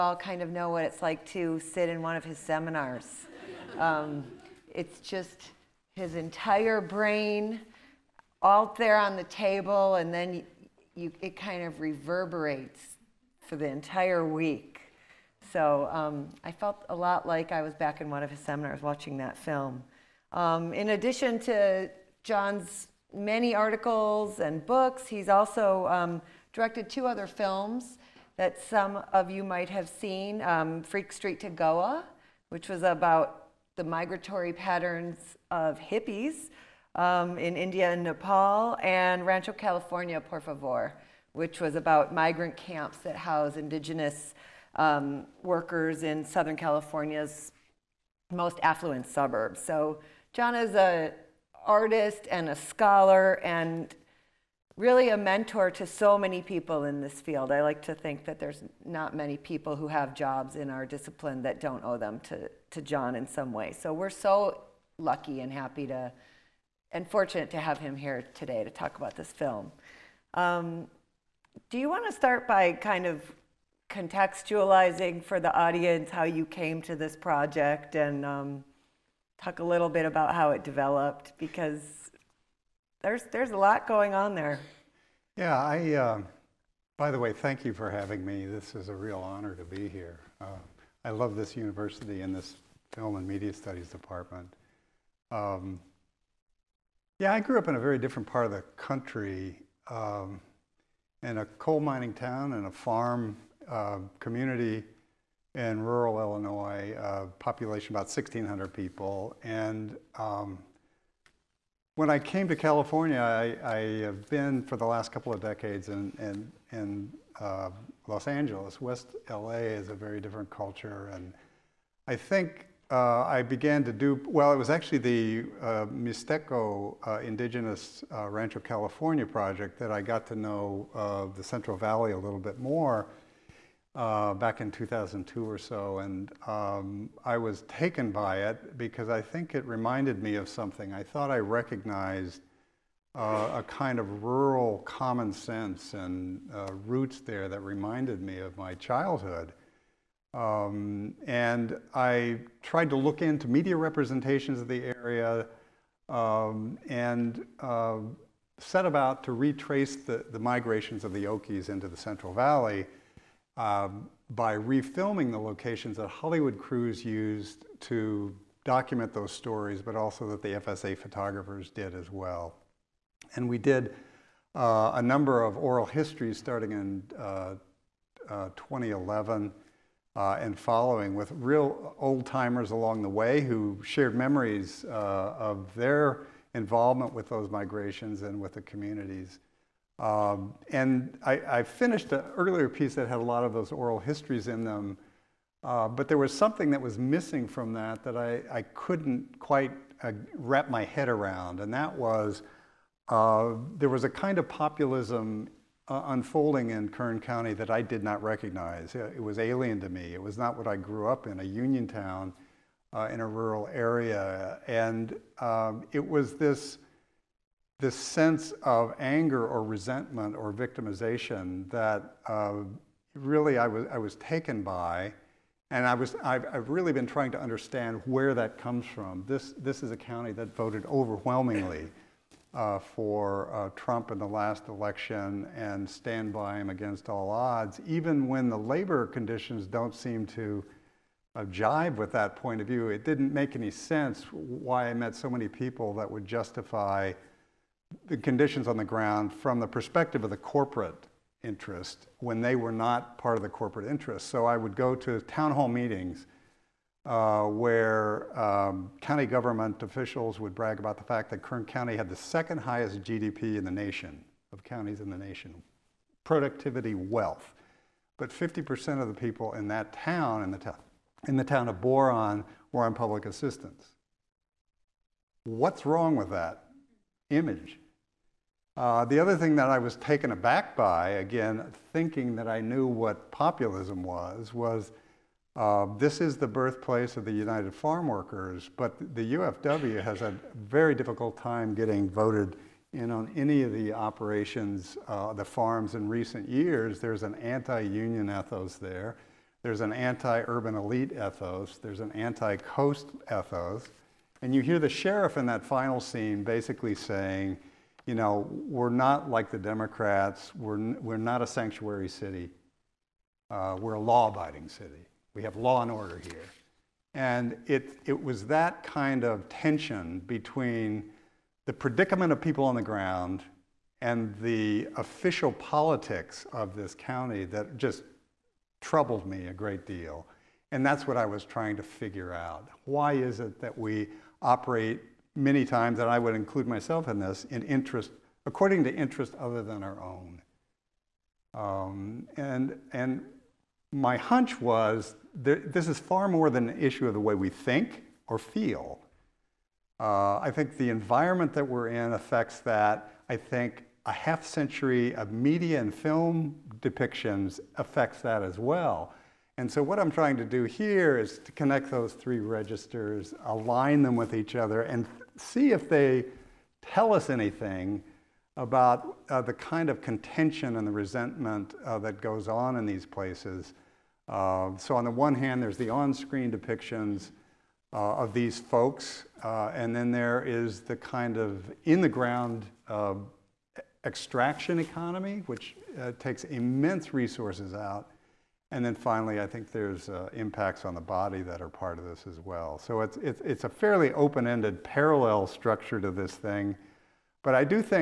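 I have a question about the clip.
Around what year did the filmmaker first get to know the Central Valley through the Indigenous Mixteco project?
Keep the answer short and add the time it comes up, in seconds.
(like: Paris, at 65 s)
2002, at 134 s.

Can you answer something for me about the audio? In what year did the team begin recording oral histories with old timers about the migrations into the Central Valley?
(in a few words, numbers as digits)
2011.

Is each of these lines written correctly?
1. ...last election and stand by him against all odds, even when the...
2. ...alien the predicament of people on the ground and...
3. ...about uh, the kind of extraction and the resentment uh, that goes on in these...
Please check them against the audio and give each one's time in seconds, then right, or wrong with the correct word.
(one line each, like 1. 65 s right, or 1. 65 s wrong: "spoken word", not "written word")
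1. 234 s right
2. 320 s wrong: "between", not "alien"
3. 368 s wrong: "contention", not "extraction".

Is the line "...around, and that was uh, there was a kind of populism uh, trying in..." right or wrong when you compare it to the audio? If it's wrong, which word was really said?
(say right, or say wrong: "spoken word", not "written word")
wrong: "unfolding", not "trying".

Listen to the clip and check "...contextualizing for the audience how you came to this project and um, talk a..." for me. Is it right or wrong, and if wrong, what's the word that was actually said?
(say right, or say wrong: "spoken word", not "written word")
right.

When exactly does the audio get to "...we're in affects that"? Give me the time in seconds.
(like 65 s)
351 s.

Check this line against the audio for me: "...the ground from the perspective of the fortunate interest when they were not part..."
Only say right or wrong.
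wrong.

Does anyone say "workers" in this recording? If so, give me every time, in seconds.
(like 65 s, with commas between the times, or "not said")
45 s, 288 s.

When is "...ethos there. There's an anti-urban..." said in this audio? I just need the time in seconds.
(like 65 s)
298 s.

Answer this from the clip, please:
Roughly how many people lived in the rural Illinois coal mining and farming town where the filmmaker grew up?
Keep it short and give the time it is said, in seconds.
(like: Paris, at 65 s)
1,600, at 108 s.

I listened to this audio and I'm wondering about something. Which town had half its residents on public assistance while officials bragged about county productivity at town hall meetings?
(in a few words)
Boron.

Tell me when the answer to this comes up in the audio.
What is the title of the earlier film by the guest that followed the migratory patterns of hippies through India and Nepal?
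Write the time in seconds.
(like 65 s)
30 s.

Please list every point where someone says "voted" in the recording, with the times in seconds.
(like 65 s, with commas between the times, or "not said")
230 s, 292 s.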